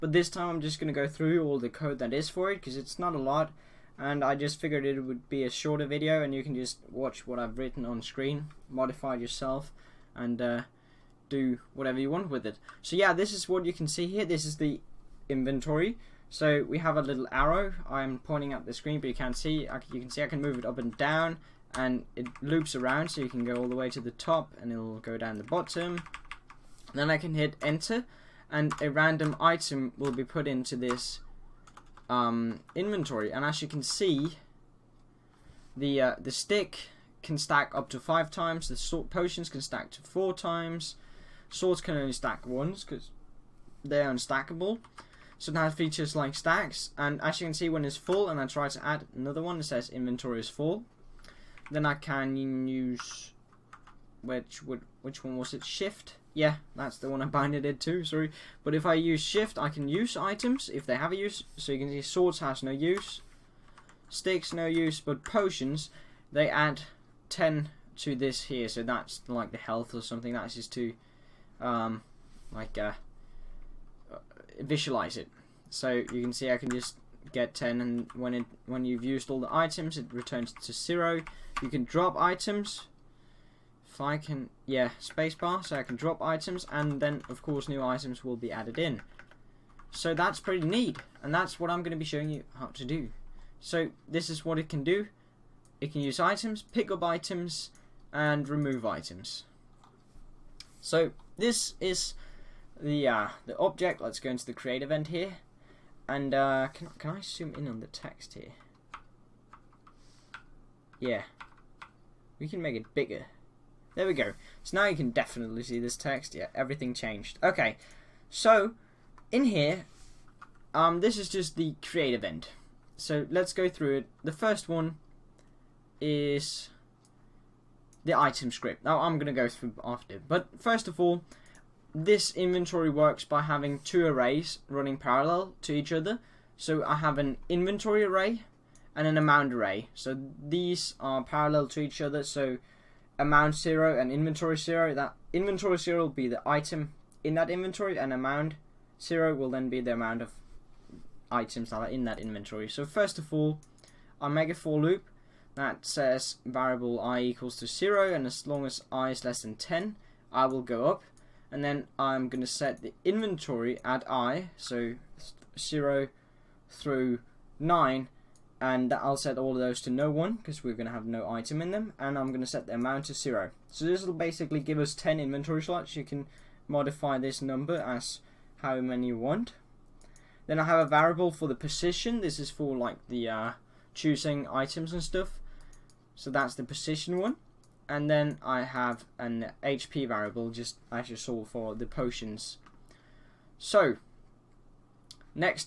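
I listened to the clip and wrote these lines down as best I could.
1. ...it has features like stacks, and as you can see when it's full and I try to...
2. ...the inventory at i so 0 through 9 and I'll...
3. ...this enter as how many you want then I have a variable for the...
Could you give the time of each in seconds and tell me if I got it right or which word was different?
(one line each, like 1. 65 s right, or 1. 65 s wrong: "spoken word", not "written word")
1. 45 s right
2. 162 s right
3. 177 s wrong: "number", not "enter".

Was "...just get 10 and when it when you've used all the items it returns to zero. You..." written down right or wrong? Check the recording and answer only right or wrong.
right.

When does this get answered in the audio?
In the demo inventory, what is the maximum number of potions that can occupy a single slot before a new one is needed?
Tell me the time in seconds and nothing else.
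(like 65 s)
40 s.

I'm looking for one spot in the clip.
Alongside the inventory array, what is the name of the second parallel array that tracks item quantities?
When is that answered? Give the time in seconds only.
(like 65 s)
139 s.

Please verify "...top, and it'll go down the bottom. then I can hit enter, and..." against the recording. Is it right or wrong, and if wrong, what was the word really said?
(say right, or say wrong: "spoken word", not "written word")
right.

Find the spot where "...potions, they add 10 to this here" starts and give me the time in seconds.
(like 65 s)
65 s.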